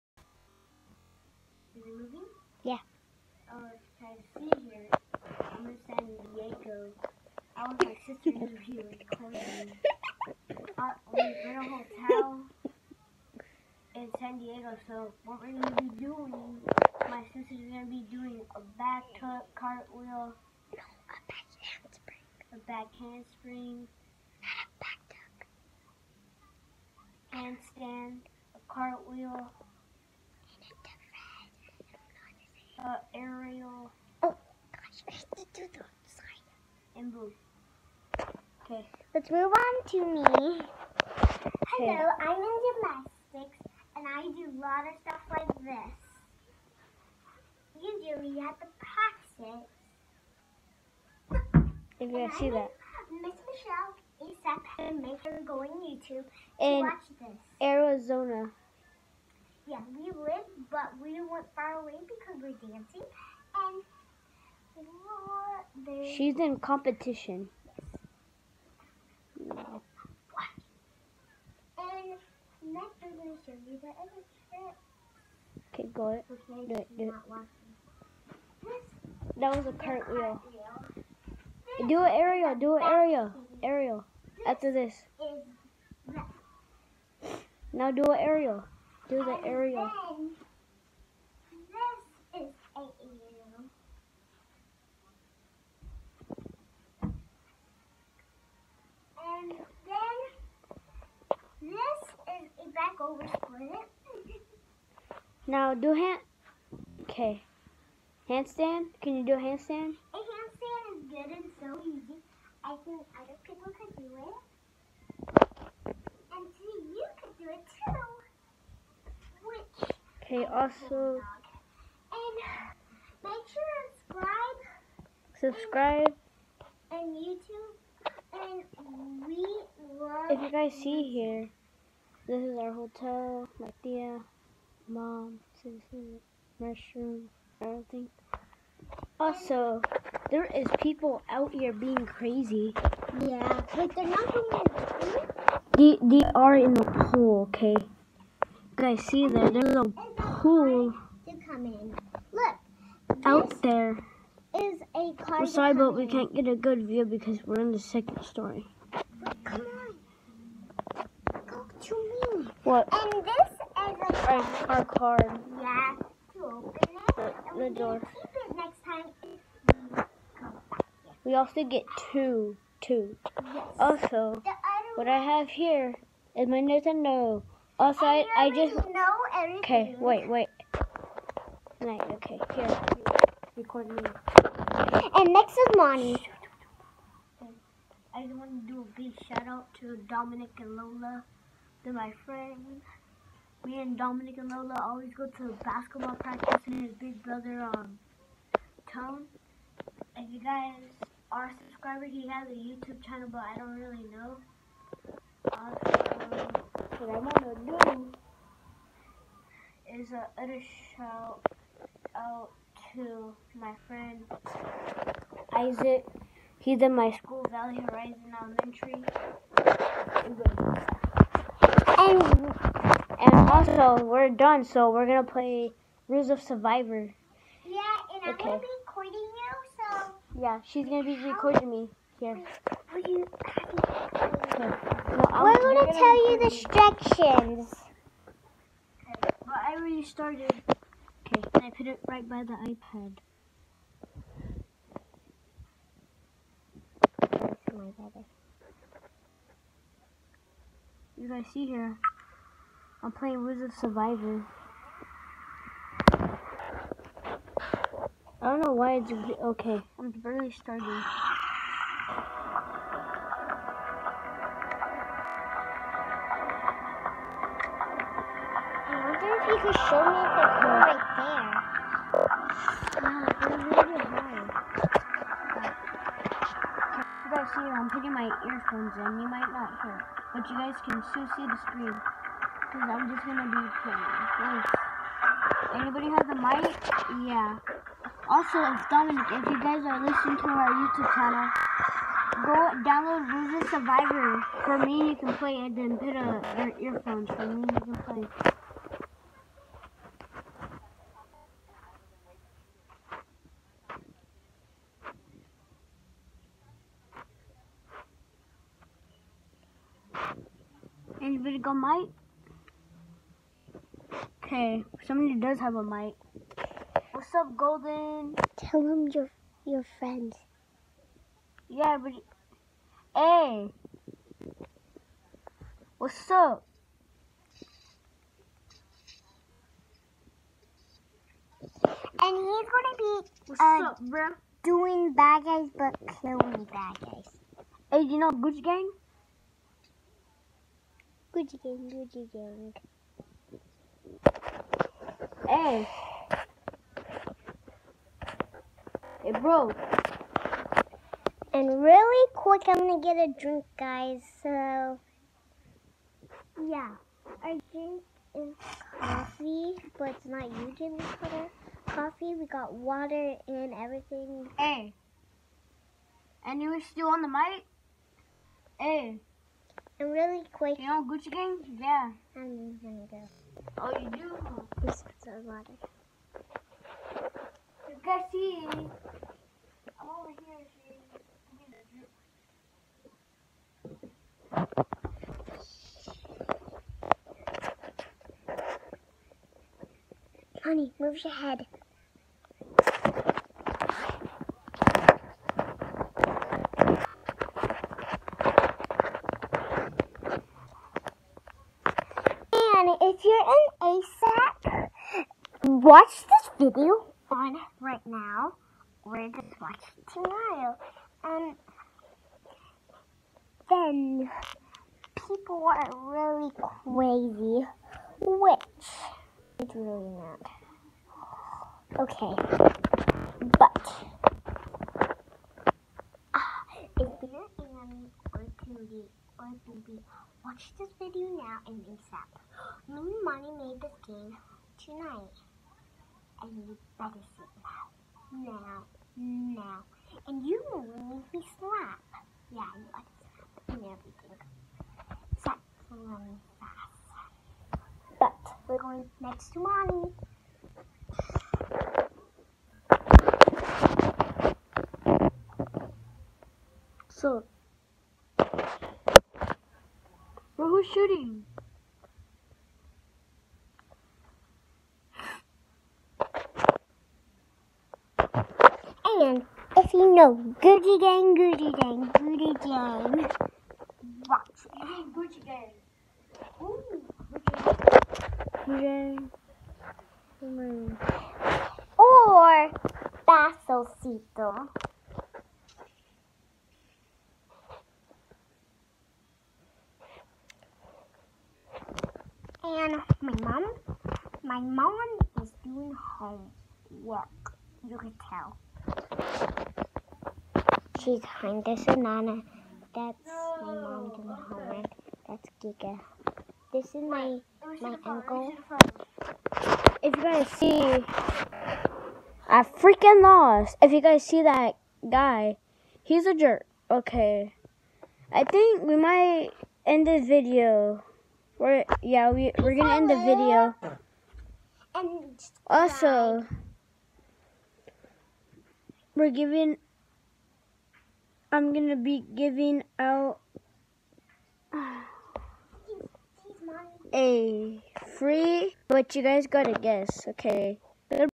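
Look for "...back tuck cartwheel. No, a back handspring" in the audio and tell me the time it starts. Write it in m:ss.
0:18.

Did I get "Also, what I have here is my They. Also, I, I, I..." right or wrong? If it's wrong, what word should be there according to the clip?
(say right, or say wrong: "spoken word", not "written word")
wrong: "Nintendo", not "They".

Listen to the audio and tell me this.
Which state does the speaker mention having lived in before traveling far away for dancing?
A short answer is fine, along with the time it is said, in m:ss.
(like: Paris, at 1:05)
Arizona, at 0:57.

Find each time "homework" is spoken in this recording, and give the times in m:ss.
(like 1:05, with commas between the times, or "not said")
8:15, 8:24.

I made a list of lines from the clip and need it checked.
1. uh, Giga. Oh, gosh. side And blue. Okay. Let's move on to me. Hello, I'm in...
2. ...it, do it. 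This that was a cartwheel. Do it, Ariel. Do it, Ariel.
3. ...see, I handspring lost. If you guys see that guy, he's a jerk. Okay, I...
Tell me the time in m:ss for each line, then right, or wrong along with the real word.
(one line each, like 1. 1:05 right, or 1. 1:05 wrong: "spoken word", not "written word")
1. 0:32 wrong: "Ariel", not "Giga"
2. 1:16 right
3. 8:30 wrong: "freaking", not "handspring".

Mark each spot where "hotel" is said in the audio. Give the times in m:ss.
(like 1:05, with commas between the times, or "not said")
0:11, 2:12.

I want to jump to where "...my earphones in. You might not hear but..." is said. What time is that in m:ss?
4:38.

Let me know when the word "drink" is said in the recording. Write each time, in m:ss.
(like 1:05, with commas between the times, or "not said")
5:53, 5:57.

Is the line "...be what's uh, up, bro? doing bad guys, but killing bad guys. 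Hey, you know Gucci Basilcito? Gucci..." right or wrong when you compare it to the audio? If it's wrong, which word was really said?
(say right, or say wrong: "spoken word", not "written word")
wrong: "Gang", not "Basilcito".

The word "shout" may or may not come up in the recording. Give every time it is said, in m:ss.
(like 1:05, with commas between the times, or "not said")
3:09, 3:30.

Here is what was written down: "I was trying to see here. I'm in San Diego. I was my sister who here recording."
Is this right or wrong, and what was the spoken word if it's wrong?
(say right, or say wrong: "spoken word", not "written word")
right.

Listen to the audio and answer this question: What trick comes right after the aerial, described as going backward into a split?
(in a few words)
Back over split.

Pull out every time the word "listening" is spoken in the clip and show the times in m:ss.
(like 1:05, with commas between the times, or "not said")
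4:50.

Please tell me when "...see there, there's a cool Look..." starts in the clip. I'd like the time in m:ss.
2:29.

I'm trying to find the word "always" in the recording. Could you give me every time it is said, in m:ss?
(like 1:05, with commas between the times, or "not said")
3:14.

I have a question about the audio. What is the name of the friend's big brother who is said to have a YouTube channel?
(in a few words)
Tone.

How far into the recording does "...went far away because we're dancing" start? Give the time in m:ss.
1:01.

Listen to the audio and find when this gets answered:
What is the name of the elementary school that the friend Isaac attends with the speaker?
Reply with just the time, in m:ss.
3:37.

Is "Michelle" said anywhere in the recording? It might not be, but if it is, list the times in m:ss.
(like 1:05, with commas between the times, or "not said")
0:53.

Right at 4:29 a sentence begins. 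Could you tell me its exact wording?
you show me if it's right there?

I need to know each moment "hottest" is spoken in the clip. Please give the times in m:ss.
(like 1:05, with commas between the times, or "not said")
not said.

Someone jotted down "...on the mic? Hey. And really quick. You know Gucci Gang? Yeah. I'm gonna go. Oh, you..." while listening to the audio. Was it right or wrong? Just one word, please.
right.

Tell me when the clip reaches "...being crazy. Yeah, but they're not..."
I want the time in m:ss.
2:21.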